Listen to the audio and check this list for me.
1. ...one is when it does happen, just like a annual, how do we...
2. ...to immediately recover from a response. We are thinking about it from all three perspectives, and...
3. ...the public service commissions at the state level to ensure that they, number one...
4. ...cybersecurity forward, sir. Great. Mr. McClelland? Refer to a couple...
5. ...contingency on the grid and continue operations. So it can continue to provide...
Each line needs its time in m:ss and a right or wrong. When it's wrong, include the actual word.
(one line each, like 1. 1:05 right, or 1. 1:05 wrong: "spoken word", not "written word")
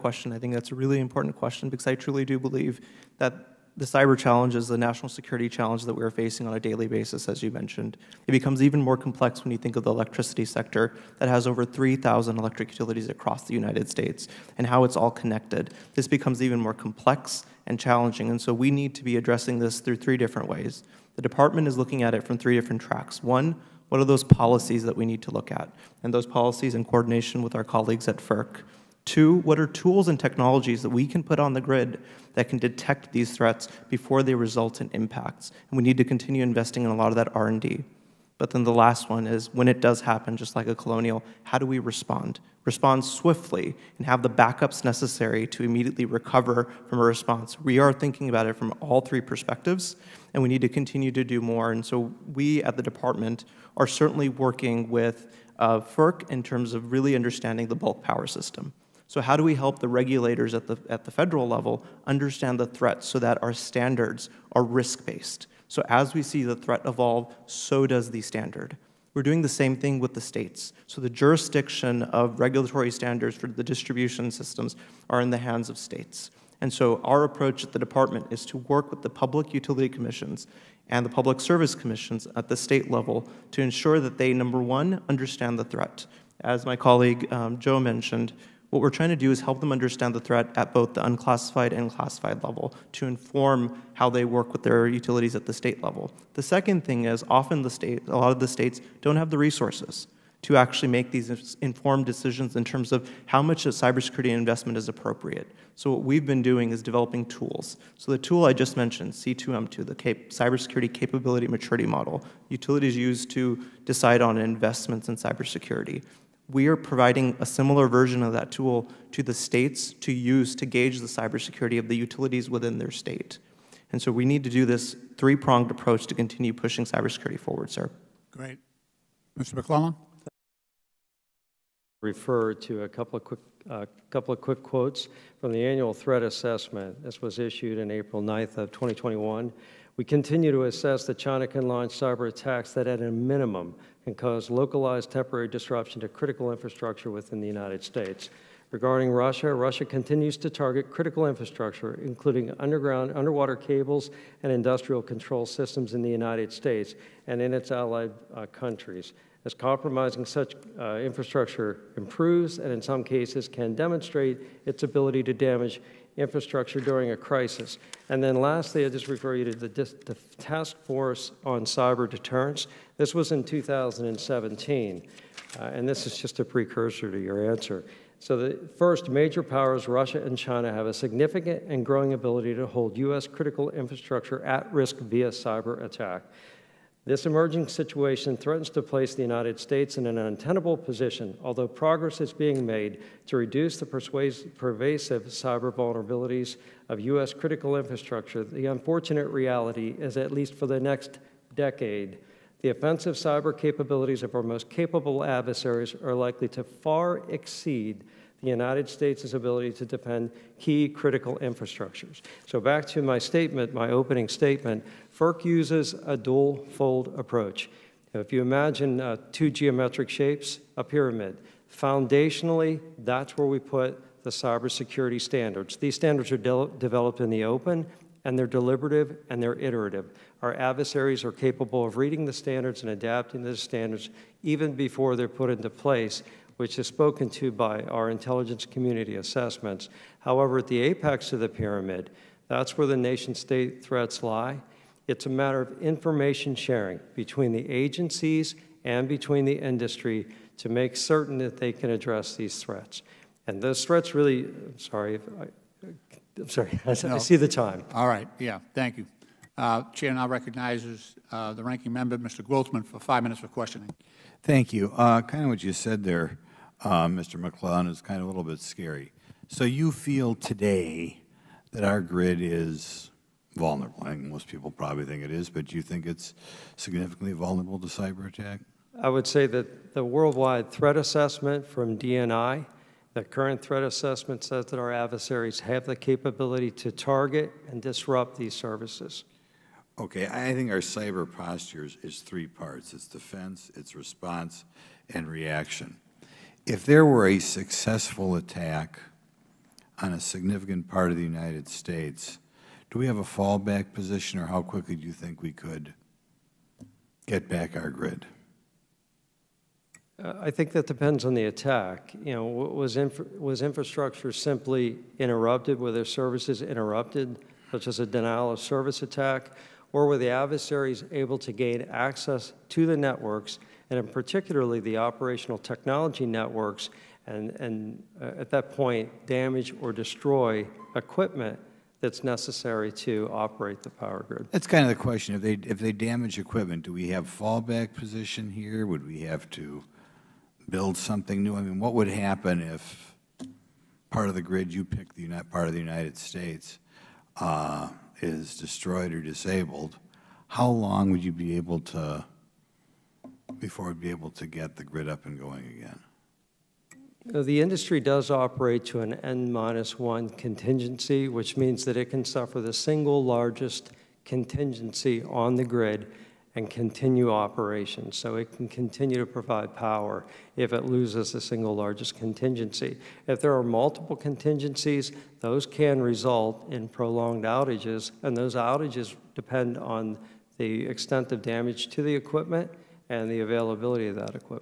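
1. 0:39 wrong: "colonial", not "annual"
2. 0:45 right
3. 1:21 right
4. 2:06 right
5. 6:04 right.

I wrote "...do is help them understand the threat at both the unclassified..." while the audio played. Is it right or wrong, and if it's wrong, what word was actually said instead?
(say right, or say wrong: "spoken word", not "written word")
right.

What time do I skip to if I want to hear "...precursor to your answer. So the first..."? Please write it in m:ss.
2:56.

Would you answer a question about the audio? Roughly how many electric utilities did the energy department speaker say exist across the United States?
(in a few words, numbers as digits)
3,000.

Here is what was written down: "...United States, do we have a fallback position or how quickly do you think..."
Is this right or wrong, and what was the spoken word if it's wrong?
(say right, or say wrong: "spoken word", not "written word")
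right.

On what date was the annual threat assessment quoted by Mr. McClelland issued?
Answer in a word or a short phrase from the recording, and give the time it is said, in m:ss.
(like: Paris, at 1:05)
April 9, 2021, at 2:17.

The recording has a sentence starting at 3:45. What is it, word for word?
These standards are de developed in the open, and they're deliberative, and they're iterative.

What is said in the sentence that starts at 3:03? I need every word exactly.
critical infrastructure at risk via cyber attack.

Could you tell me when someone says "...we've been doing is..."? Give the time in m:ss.
1:46.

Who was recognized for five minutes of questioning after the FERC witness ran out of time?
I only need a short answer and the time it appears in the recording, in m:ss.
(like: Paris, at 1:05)
Mr. Grothman, at 4:22.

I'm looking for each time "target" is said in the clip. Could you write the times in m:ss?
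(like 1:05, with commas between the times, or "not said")
2:30, 4:46.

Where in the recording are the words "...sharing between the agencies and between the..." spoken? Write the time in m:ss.
4:06.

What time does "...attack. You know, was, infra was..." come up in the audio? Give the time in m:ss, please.
5:11.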